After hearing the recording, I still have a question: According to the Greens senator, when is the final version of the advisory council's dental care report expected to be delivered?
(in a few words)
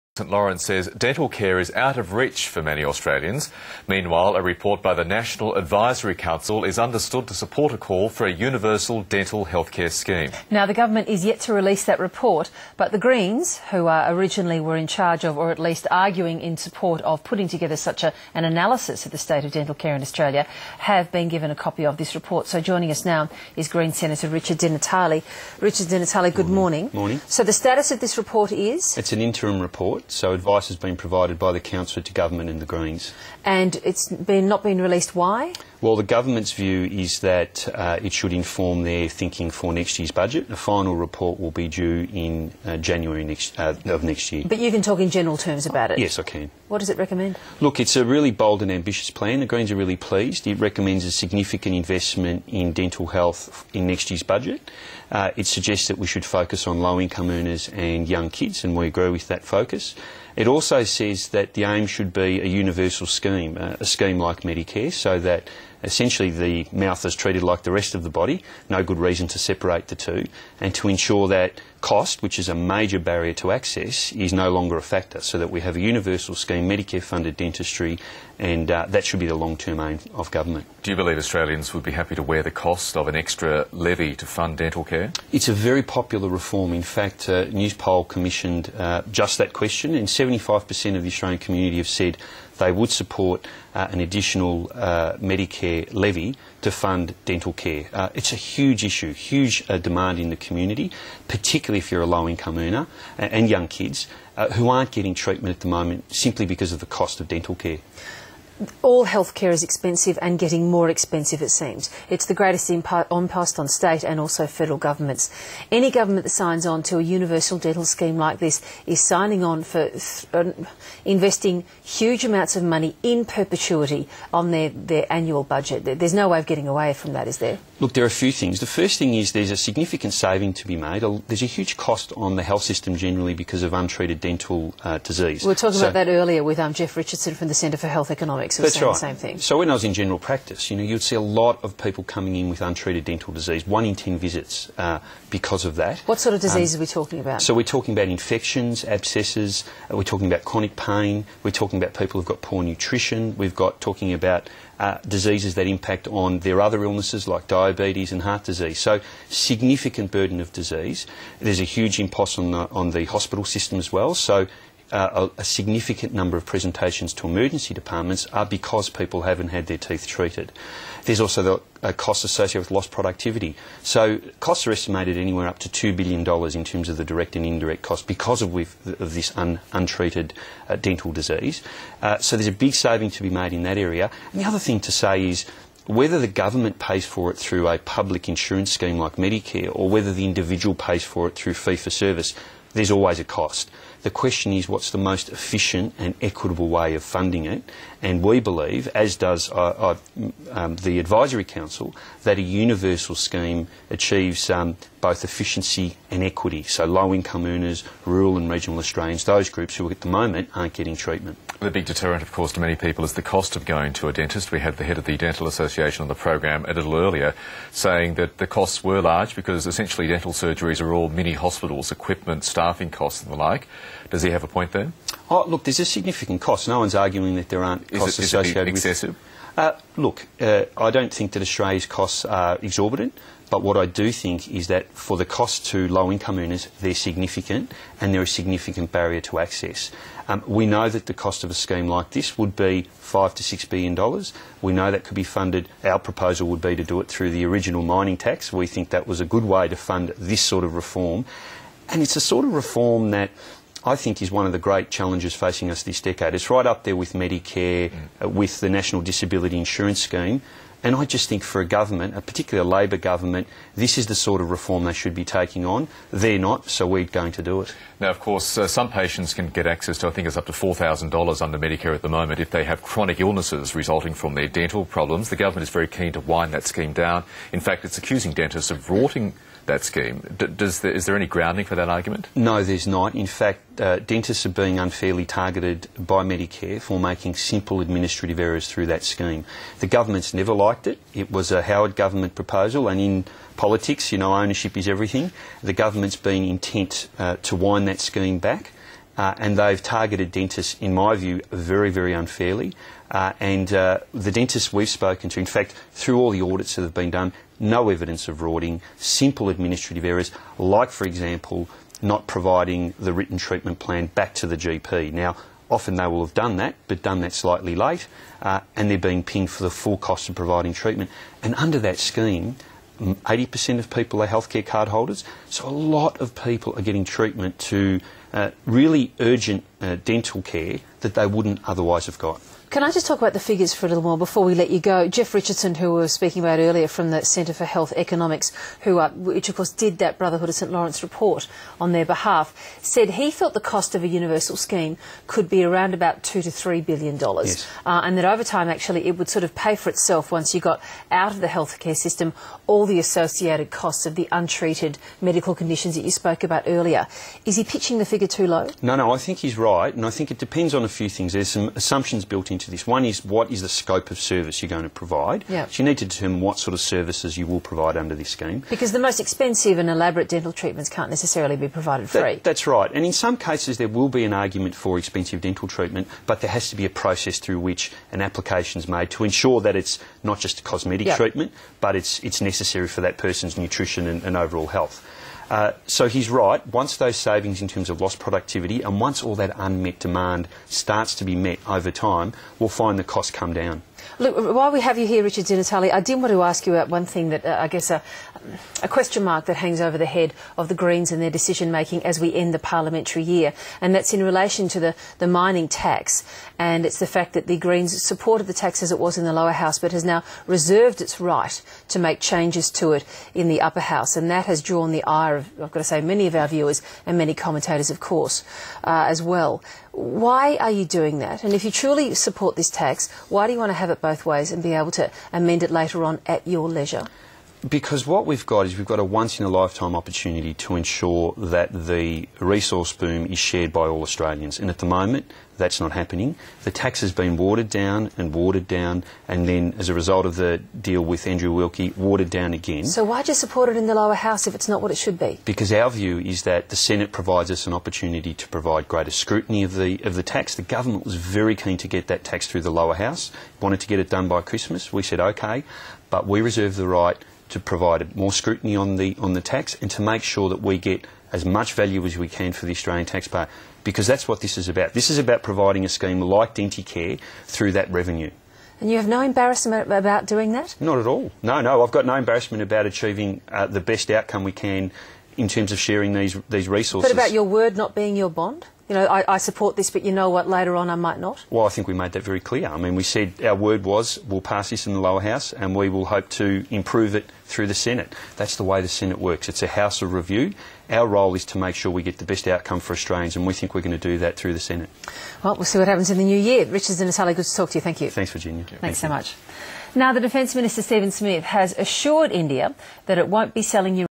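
January.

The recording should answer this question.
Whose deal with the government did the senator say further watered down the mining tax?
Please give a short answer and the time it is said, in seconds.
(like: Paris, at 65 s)
Andrew Wilkie, at 441 s.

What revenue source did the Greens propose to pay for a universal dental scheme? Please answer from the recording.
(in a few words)
the original mining tax.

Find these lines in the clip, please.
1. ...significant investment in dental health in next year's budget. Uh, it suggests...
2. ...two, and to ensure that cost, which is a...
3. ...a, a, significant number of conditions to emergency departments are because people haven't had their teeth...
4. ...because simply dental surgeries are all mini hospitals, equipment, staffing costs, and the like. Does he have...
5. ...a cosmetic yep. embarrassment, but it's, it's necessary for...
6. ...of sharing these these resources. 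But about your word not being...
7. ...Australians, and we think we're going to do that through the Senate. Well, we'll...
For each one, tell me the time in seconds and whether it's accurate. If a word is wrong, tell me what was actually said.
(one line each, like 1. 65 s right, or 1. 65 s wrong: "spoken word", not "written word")
1. 51 s right
2. 69 s right
3. 165 s wrong: "presentations", not "conditions"
4. 219 s wrong: "essentially", not "simply"
5. 380 s wrong: "treatment", not "embarrassment"
6. 475 s right
7. 492 s right.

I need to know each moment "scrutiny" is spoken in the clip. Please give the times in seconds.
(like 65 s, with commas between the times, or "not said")
449 s, 458 s.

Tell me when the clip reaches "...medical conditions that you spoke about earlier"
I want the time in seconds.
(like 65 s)
355 s.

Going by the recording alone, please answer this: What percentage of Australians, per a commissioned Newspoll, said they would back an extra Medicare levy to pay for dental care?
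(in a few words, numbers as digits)
75%.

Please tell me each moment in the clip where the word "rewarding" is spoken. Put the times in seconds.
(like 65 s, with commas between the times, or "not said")
not said.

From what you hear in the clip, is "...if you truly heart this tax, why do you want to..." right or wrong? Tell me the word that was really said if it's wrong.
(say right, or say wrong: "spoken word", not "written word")
wrong: "support", not "heart".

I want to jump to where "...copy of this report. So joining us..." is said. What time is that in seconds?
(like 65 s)
21 s.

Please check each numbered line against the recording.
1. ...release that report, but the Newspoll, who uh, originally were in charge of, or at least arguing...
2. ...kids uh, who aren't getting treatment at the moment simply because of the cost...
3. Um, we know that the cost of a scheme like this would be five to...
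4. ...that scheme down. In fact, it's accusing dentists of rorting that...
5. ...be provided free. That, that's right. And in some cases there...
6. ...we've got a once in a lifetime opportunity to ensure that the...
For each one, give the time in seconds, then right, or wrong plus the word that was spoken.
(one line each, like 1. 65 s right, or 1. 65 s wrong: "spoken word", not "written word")
1. 11 s wrong: "Greens", not "Newspoll"
2. 103 s right
3. 240 s right
4. 276 s right
5. 371 s right
6. 428 s right.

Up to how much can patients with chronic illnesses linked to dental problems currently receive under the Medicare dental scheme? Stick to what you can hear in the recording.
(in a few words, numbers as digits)
$4,000.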